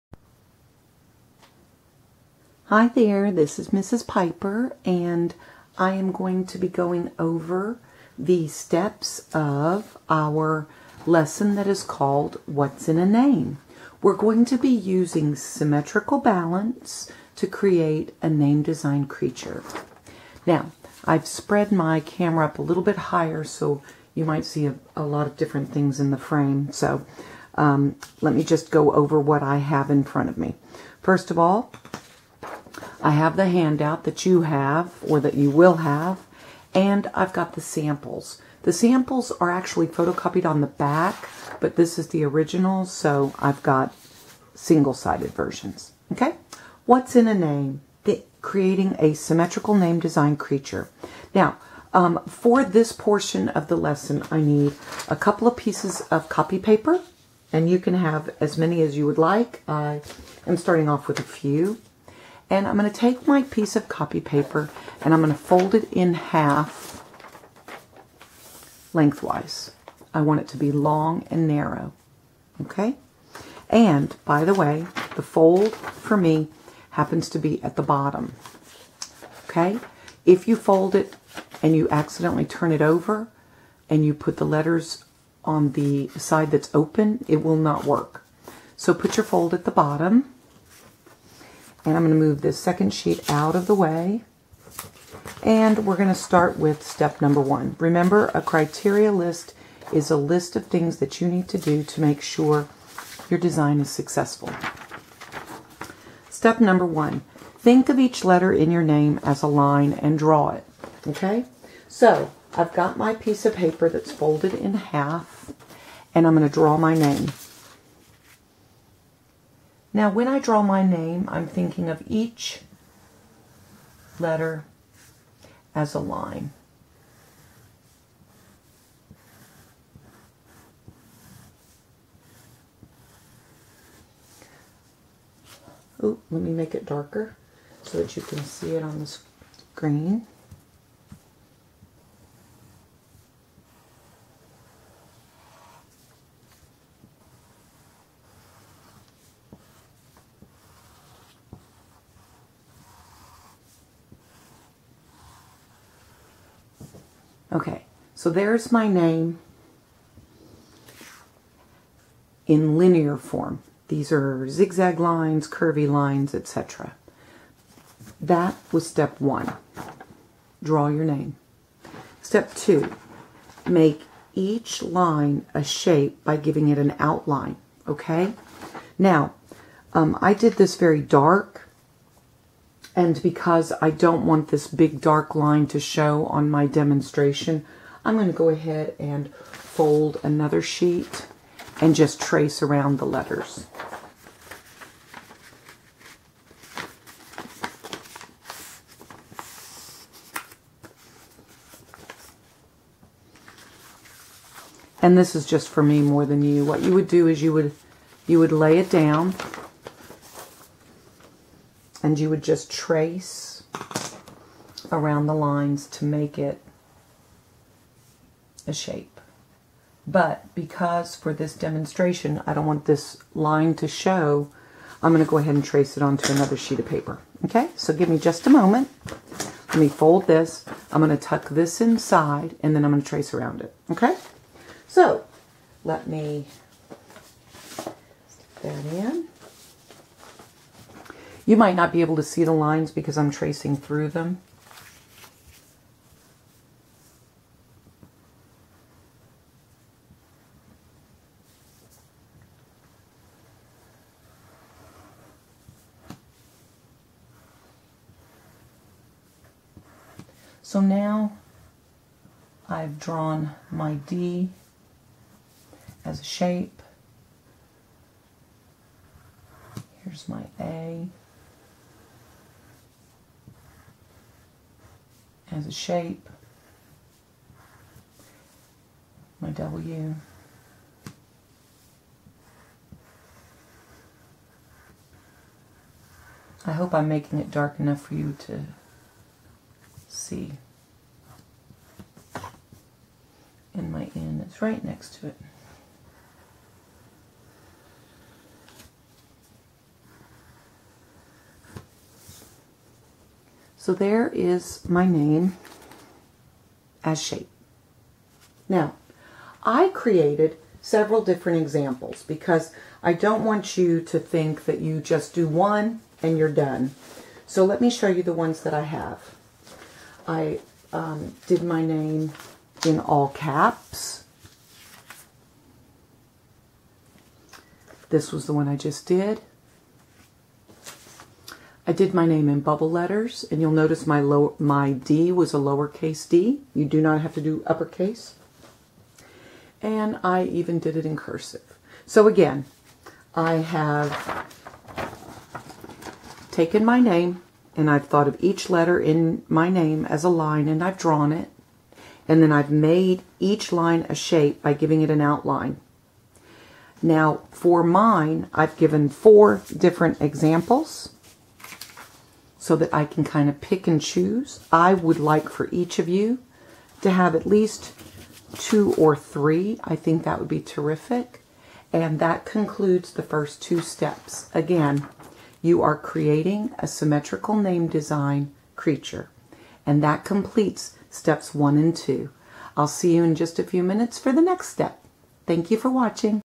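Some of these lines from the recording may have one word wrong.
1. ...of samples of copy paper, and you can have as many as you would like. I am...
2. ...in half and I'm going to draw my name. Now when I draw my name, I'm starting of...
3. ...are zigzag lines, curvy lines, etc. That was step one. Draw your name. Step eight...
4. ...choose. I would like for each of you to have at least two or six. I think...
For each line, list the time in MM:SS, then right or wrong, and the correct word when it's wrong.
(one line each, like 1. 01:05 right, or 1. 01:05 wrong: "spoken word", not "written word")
1. 00:55 wrong: "pieces", not "samples"
2. 01:54 wrong: "thinking", not "starting"
3. 02:44 wrong: "two", not "eight"
4. 06:03 wrong: "three", not "six".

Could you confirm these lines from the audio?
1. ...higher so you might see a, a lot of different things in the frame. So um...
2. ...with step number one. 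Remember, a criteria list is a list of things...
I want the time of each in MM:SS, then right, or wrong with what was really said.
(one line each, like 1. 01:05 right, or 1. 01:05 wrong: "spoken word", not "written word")
1. 00:23 right
2. 01:36 right.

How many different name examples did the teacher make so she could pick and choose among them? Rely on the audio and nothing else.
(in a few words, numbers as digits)
4.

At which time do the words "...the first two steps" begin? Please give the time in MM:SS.
06:13.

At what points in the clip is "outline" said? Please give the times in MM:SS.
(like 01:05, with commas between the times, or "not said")
02:56, 05:55.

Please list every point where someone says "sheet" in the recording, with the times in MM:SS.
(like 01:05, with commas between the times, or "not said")
01:32, 03:10, 03:46.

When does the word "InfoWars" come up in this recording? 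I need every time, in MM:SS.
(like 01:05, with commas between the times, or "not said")
not said.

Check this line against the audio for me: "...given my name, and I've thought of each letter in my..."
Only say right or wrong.
wrong.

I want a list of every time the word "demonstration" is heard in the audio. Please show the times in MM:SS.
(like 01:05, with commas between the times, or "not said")
03:06, 03:41.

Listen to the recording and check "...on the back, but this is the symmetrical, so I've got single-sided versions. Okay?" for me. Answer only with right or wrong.
wrong.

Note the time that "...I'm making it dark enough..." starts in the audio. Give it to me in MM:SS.
04:46.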